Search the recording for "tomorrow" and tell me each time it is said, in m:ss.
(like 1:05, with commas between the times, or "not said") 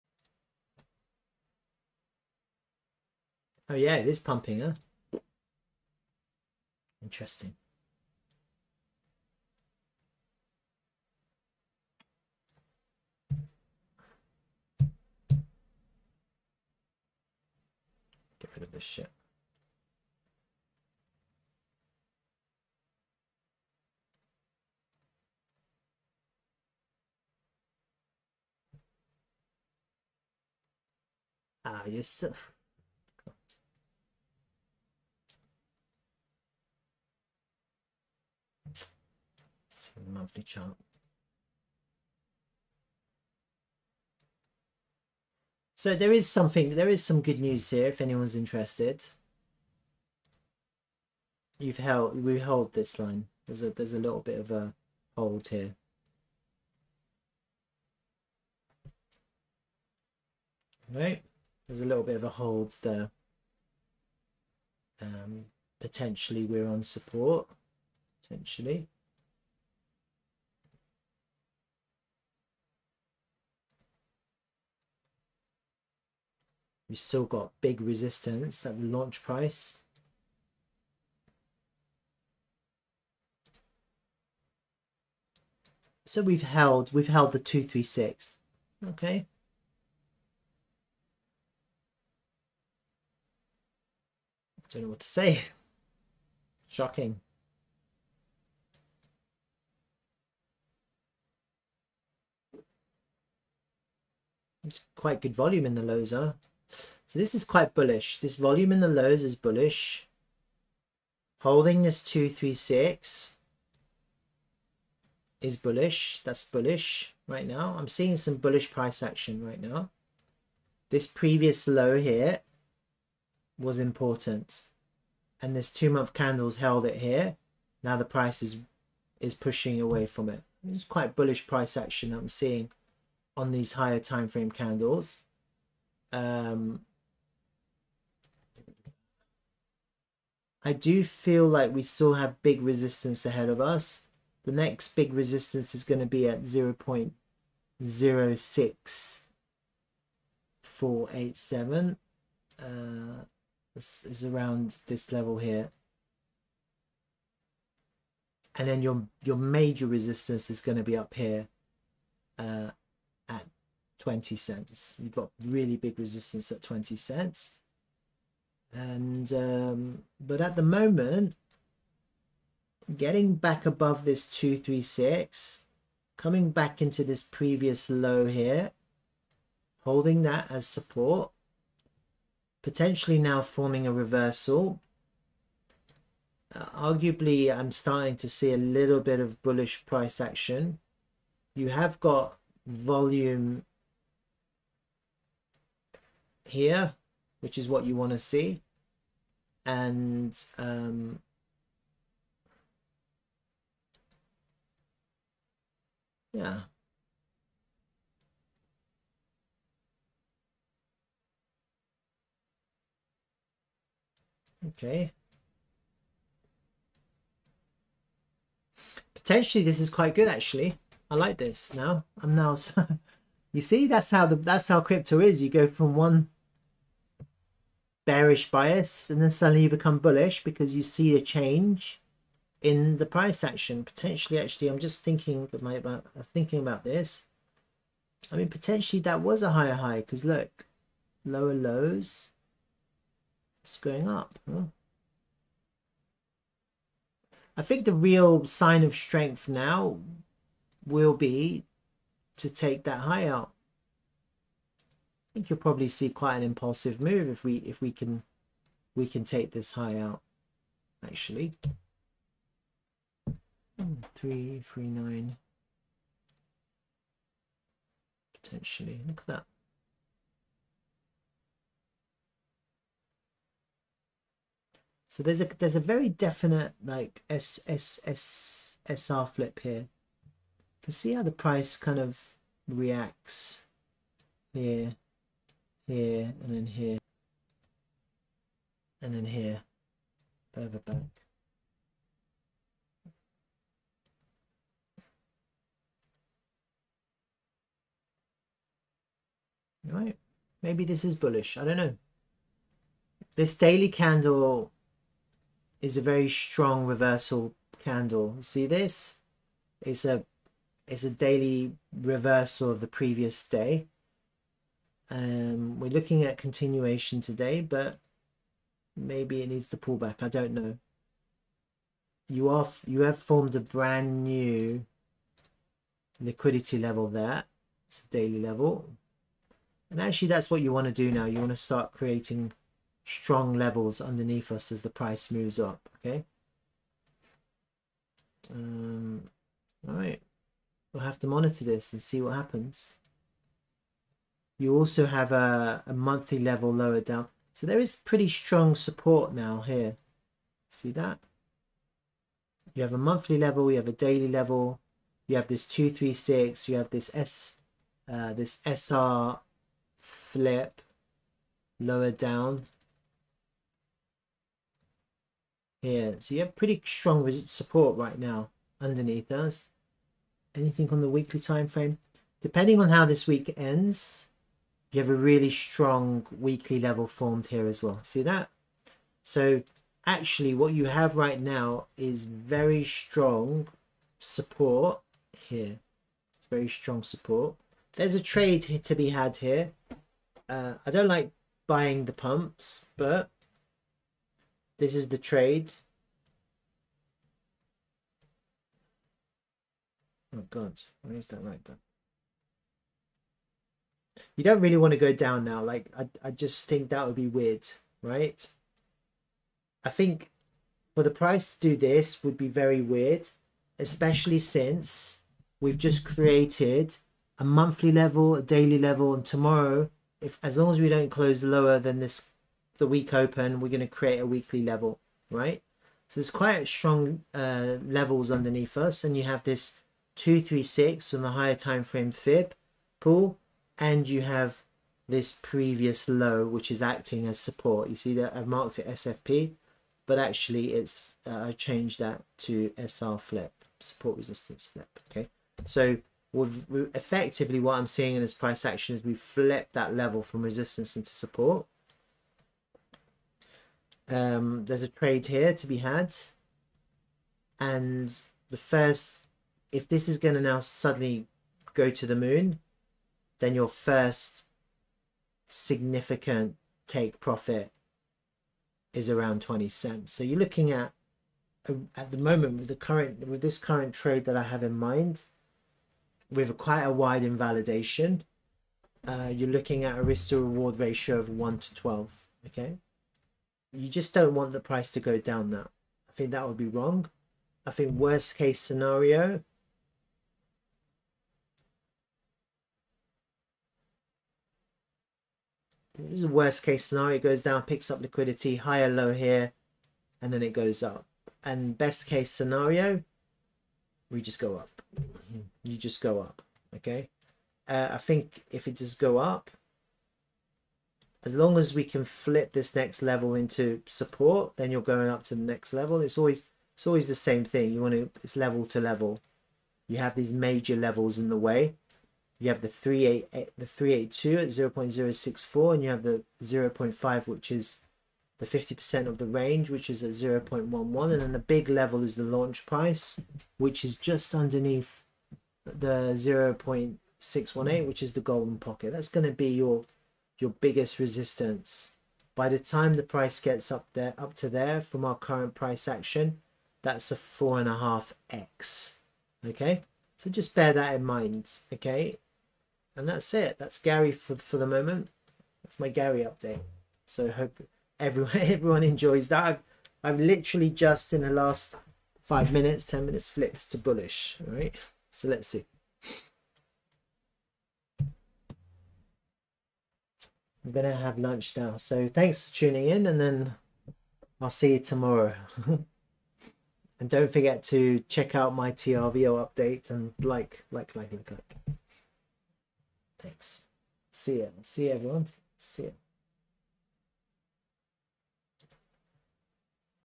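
6:59, 9:34.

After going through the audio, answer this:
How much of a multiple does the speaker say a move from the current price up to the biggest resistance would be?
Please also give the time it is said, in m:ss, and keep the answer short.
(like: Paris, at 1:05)
4.5x, at 9:07.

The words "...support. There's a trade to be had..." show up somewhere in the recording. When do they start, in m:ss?
6:27.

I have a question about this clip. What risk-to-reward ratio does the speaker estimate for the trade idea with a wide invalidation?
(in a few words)
1 to 12.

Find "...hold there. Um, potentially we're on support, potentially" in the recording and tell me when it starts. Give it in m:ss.
1:02.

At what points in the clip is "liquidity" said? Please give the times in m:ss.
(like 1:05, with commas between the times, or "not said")
5:26, 8:18.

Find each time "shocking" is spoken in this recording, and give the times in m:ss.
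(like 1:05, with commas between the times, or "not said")
1:36.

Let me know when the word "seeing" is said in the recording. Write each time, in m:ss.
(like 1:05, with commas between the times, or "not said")
1:57, 2:12, 7:27.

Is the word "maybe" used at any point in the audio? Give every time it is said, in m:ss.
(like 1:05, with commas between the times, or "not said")
5:00, 5:18.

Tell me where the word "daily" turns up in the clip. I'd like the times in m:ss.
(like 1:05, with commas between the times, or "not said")
5:03, 5:11, 5:28, 5:54, 6:58.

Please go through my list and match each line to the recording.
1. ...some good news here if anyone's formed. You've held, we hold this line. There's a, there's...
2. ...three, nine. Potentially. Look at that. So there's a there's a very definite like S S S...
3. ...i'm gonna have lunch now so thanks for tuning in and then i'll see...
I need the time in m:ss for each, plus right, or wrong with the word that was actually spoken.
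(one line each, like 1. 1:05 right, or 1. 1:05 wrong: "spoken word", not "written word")
1. 0:47 wrong: "interested", not "formed"
2. 4:24 right
3. 9:27 right.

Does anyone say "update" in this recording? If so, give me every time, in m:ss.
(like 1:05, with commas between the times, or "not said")
9:16, 9:39.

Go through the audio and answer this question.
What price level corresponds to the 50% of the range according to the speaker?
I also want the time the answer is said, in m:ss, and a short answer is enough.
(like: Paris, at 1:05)
0.11, at 8:50.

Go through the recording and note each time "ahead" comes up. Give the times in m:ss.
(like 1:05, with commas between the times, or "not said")
2:23.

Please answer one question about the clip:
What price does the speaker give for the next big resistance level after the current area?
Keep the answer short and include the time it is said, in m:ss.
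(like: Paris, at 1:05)
0.06487, at 2:26.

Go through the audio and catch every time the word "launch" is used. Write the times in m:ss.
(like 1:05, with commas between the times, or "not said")
1:18, 8:52.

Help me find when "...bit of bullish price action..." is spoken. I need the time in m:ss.
3:08.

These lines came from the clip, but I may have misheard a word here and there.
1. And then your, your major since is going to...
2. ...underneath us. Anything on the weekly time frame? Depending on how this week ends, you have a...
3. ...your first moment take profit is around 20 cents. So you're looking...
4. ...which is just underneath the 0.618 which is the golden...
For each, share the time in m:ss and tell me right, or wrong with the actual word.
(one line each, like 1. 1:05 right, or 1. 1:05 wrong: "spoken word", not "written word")
1. 2:38 wrong: "resistance", not "since"
2. 6:08 right
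3. 7:43 wrong: "significant", not "moment"
4. 8:53 right.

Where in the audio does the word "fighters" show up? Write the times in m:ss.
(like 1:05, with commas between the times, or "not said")
not said.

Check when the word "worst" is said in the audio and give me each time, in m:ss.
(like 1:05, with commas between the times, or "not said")
8:07, 8:16.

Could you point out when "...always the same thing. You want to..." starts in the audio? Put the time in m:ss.
8:36.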